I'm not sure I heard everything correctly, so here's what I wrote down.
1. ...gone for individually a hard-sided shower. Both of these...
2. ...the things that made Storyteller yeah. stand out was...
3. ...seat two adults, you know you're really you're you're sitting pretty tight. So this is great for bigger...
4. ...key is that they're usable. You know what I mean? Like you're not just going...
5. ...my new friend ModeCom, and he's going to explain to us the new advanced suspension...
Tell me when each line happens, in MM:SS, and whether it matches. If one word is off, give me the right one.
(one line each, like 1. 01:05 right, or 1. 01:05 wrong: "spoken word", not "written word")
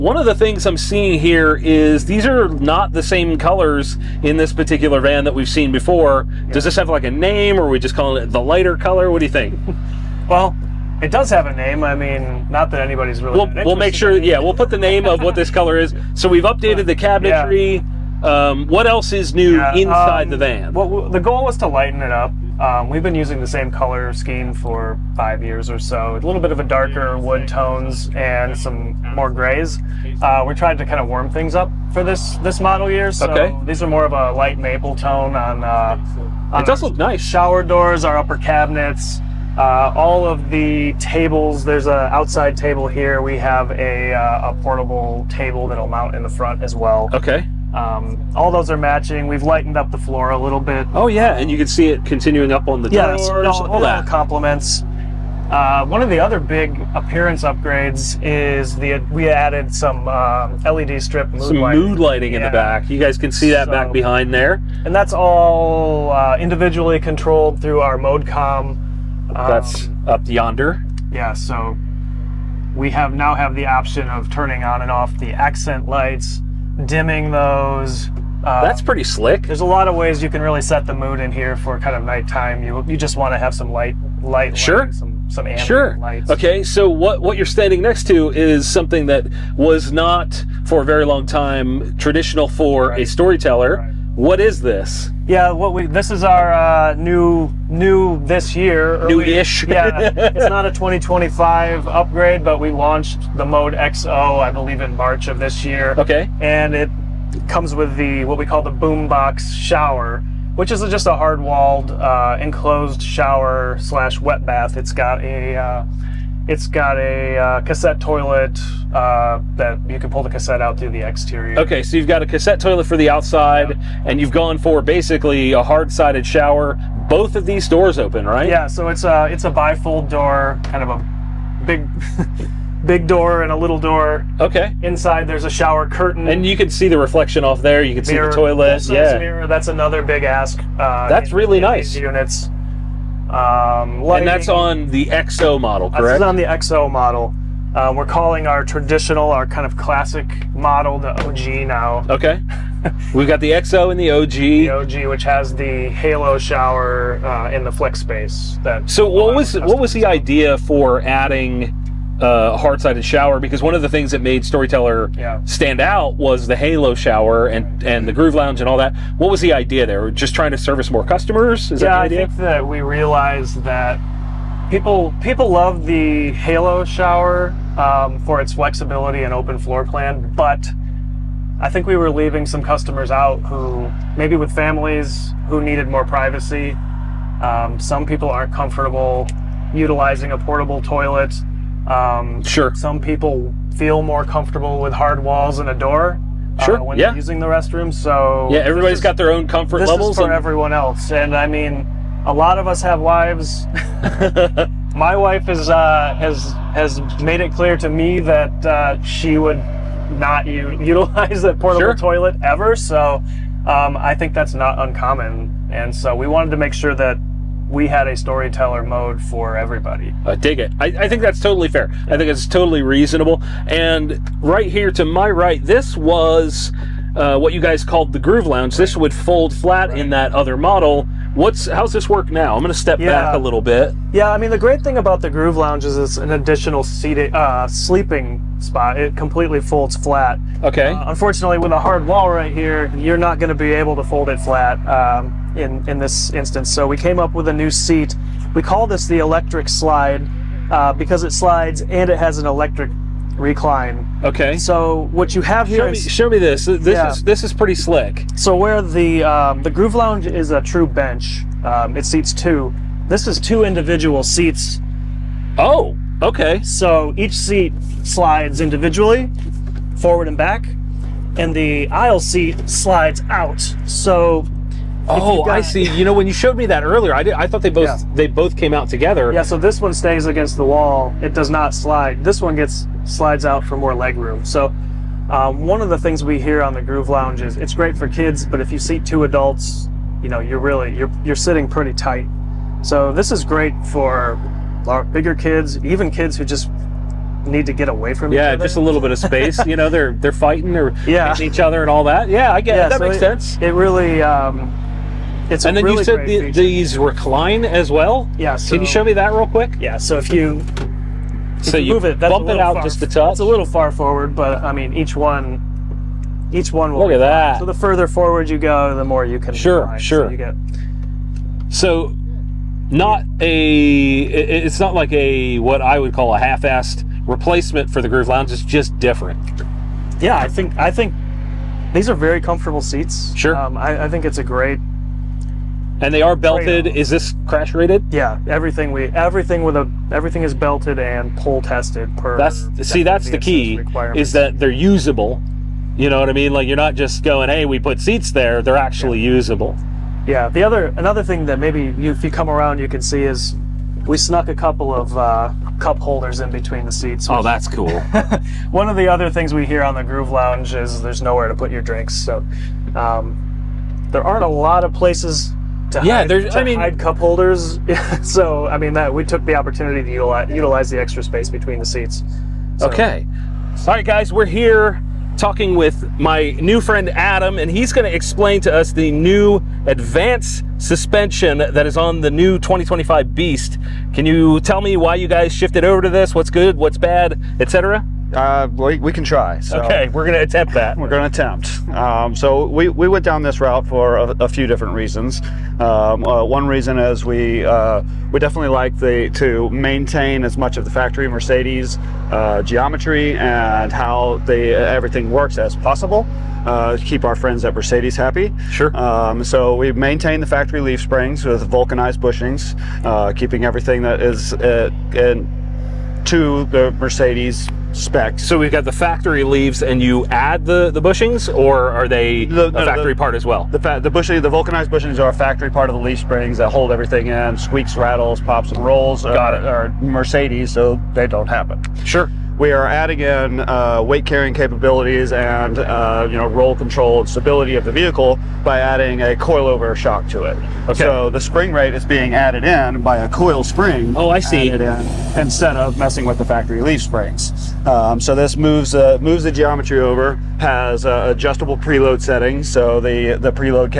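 1. 02:04 wrong: "basically", not "individually"
2. 02:43 right
3. 04:48 right
4. 05:43 right
5. 06:16 wrong: "Adam", not "ModeCom".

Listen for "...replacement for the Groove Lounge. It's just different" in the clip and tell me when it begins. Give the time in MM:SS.
05:27.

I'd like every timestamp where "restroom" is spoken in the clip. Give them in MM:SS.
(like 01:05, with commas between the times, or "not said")
03:17.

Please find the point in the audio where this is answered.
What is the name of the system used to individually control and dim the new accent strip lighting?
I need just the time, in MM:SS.
01:07.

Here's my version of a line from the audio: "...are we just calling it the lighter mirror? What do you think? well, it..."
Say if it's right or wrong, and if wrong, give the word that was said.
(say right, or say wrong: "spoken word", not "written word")
wrong: "color", not "mirror".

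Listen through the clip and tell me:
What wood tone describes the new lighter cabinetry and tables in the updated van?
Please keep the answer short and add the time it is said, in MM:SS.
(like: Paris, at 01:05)
light maple, at 00:34.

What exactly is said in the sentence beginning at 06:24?
Can you tell me why you guys shifted over to this?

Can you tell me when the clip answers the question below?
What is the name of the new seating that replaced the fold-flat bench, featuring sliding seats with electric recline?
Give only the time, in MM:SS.
04:09.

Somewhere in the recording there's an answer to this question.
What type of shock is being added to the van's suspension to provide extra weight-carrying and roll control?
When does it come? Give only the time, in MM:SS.
07:19.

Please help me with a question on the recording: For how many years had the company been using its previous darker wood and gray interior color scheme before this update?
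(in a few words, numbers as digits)
5.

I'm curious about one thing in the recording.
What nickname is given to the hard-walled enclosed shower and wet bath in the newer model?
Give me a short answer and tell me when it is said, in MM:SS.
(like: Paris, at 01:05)
boombox shower, at 01:48.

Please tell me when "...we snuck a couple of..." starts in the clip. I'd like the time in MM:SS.
05:54.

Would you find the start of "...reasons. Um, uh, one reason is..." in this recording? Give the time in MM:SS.
06:34.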